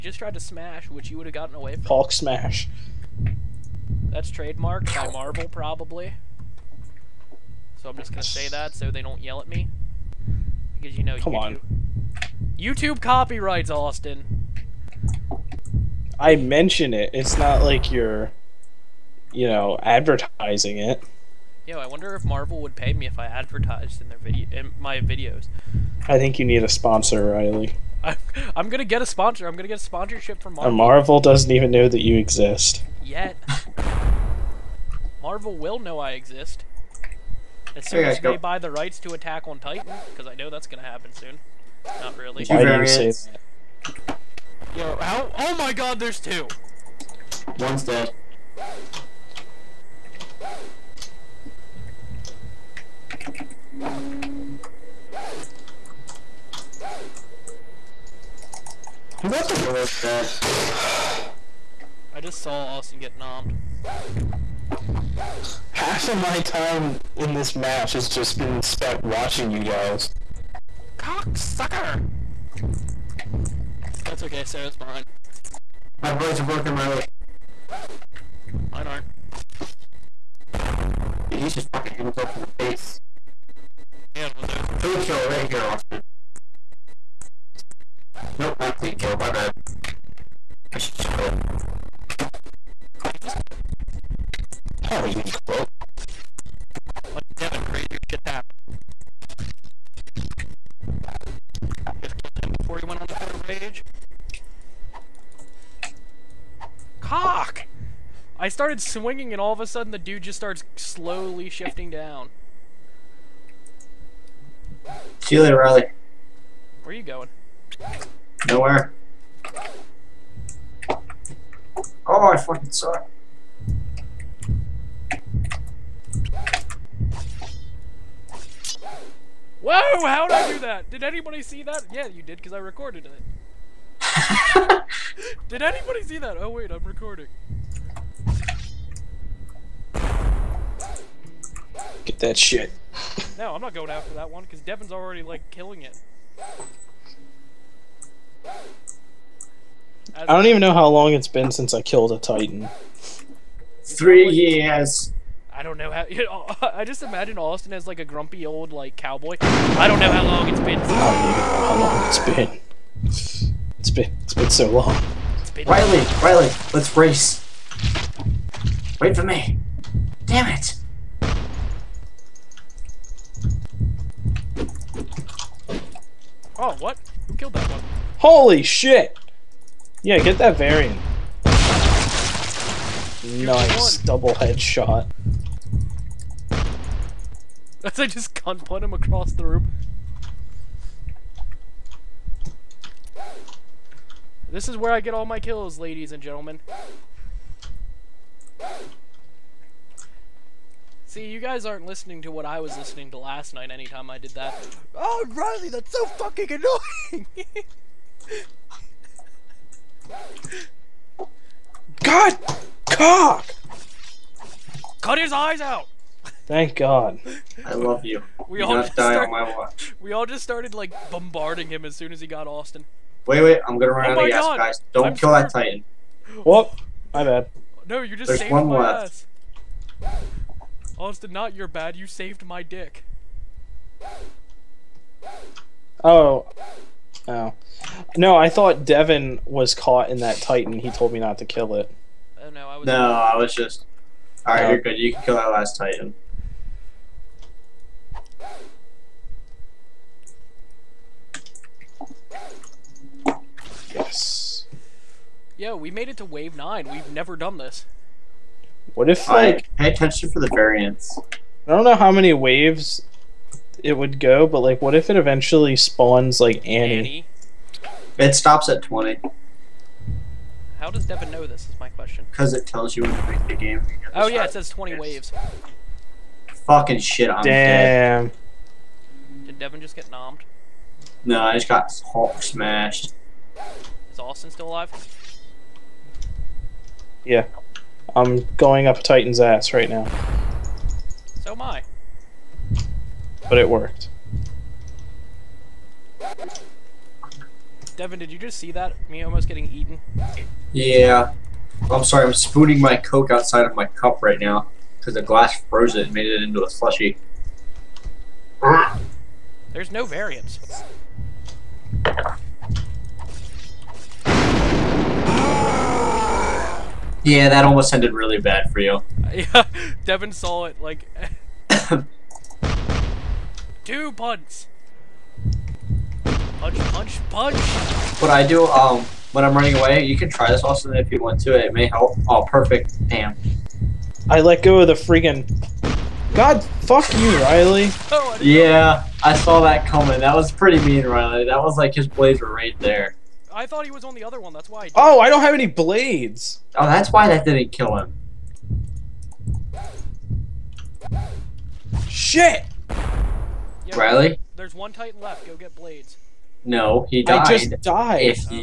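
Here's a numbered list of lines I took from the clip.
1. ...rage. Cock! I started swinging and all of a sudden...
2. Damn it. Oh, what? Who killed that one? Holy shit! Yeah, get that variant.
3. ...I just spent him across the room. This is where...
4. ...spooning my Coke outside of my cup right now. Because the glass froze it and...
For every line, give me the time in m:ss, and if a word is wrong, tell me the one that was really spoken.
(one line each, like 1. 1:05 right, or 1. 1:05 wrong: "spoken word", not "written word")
1. 1:43 right
2. 2:50 right
3. 3:07 wrong: "gunpoint", not "spent"
4. 5:02 right.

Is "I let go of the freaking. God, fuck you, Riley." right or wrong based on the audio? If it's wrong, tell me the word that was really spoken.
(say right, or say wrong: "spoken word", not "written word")
right.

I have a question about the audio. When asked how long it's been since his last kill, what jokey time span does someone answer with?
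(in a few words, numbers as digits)
3 years.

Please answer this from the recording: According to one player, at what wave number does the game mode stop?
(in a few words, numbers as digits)
20.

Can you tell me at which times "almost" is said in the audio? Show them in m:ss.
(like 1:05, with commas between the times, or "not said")
4:59, 5:17.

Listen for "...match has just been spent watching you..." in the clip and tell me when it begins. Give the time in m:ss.
1:07.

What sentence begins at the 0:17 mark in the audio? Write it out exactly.
It's not like you're, you know, advertising it.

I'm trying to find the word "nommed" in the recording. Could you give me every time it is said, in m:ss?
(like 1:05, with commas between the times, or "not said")
1:03, 4:40.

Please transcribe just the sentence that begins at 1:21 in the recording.
Dude, he's just fucking hitting himself in the face.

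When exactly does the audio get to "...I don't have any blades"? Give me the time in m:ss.
5:45.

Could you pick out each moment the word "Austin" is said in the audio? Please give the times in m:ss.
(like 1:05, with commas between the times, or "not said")
0:13, 1:02, 1:25, 2:37, 3:42, 3:50, 4:44.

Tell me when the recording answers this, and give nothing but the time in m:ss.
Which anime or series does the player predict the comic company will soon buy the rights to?
0:39.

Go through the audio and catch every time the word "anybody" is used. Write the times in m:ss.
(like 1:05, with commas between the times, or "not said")
2:11, 2:15.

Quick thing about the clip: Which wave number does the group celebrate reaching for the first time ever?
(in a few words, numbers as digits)
9.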